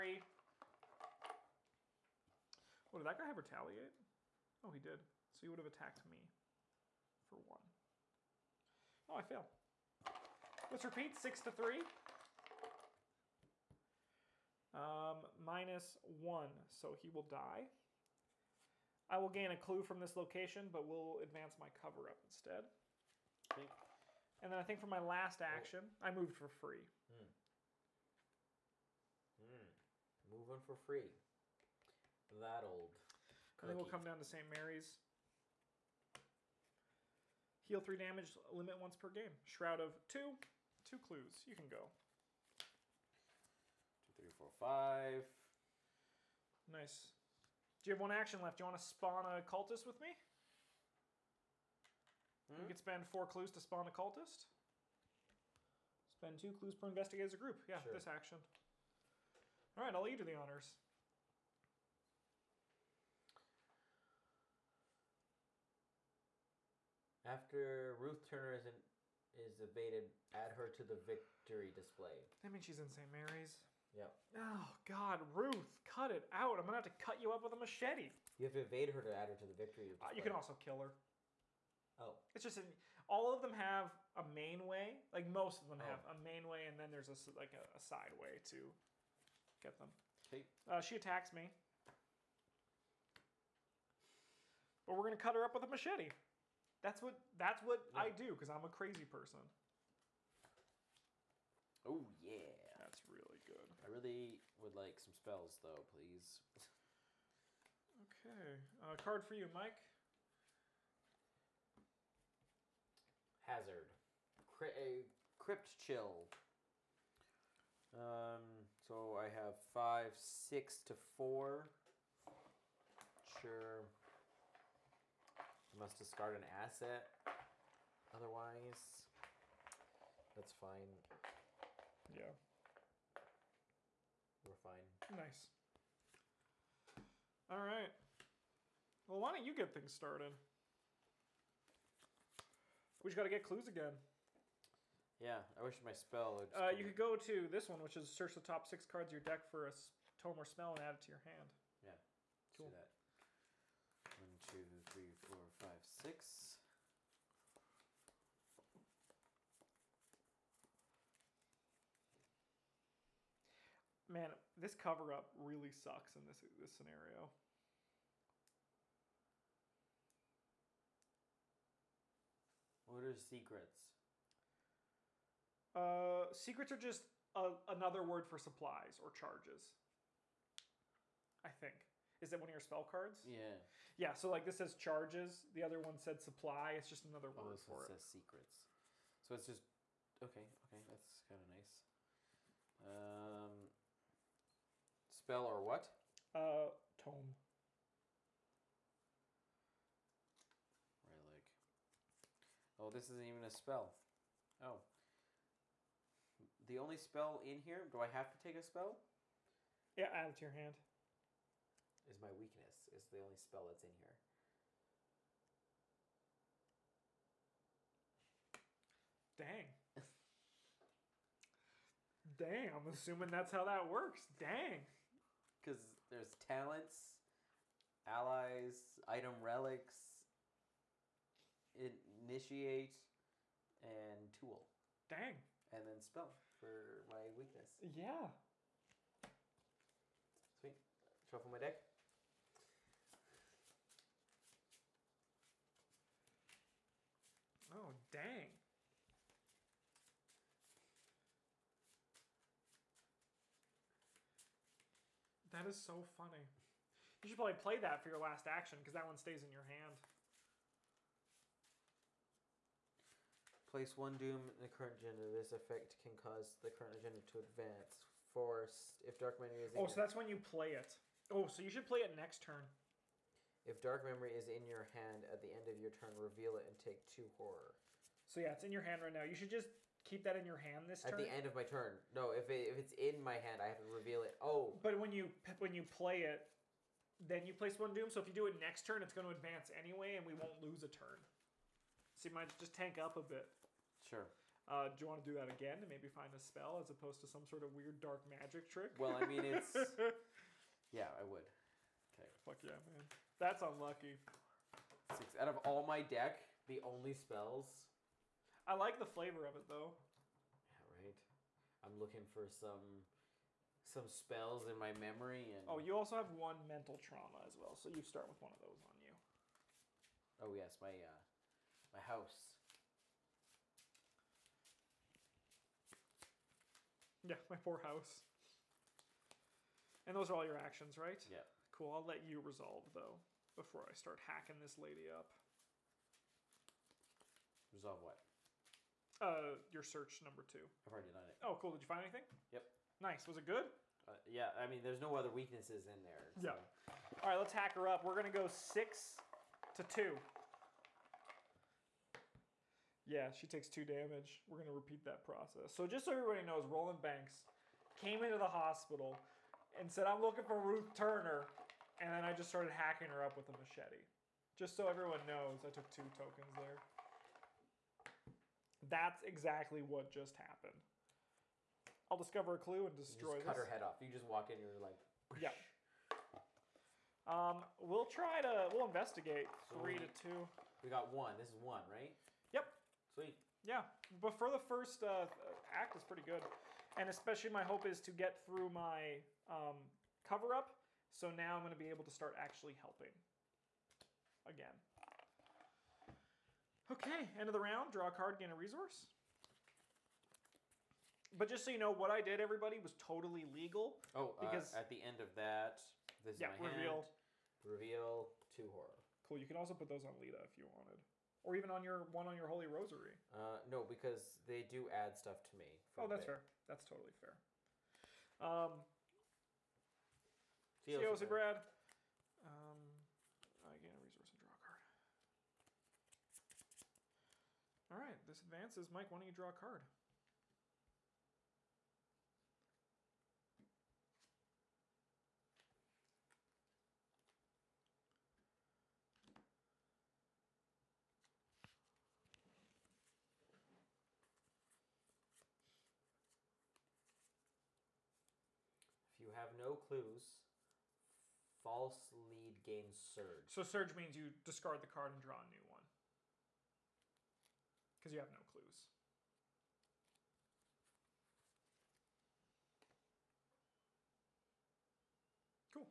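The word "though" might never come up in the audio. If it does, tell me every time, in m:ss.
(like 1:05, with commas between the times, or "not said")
1:45, 5:09, 5:32.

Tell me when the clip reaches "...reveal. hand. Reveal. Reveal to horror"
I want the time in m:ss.
6:46.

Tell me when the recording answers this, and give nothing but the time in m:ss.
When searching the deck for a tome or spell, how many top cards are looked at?
2:28.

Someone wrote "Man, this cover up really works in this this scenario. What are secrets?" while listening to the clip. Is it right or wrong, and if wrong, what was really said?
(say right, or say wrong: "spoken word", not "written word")
wrong: "sucks", not "works".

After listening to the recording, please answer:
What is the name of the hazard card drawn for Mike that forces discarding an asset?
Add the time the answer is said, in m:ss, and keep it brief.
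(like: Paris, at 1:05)
Crypt Chill, at 1:55.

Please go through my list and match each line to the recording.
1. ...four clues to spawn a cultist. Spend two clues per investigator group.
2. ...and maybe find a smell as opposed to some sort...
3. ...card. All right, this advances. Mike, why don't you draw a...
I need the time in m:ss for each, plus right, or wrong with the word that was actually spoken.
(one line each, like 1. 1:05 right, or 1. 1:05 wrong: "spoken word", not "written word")
1. 0:53 right
2. 4:55 wrong: "spell", not "smell"
3. 7:04 right.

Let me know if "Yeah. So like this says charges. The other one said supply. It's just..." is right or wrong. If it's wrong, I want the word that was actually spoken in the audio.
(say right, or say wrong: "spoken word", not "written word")
right.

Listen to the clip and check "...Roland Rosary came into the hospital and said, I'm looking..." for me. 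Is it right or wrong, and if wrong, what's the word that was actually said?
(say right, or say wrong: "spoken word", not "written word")
wrong: "Banks", not "Rosary".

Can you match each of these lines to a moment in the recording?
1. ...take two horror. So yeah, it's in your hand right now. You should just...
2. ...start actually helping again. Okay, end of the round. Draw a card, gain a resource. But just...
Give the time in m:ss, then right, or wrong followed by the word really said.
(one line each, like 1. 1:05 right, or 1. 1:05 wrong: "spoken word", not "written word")
1. 4:36 right
2. 6:32 right.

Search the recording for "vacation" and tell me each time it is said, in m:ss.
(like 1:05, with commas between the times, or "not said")
not said.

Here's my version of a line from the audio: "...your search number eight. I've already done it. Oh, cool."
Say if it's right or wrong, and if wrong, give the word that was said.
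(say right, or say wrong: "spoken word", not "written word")
wrong: "two", not "eight".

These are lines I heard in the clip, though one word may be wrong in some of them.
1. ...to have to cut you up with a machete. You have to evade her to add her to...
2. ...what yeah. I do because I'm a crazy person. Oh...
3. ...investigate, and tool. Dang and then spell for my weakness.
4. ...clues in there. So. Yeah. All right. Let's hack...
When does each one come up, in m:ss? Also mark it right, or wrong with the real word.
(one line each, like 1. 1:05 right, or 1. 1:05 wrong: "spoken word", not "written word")
1. 1:16 right
2. 1:37 right
3. 3:51 wrong: "initiate", not "investigate"
4. 5:45 wrong: "weaknesses", not "clues".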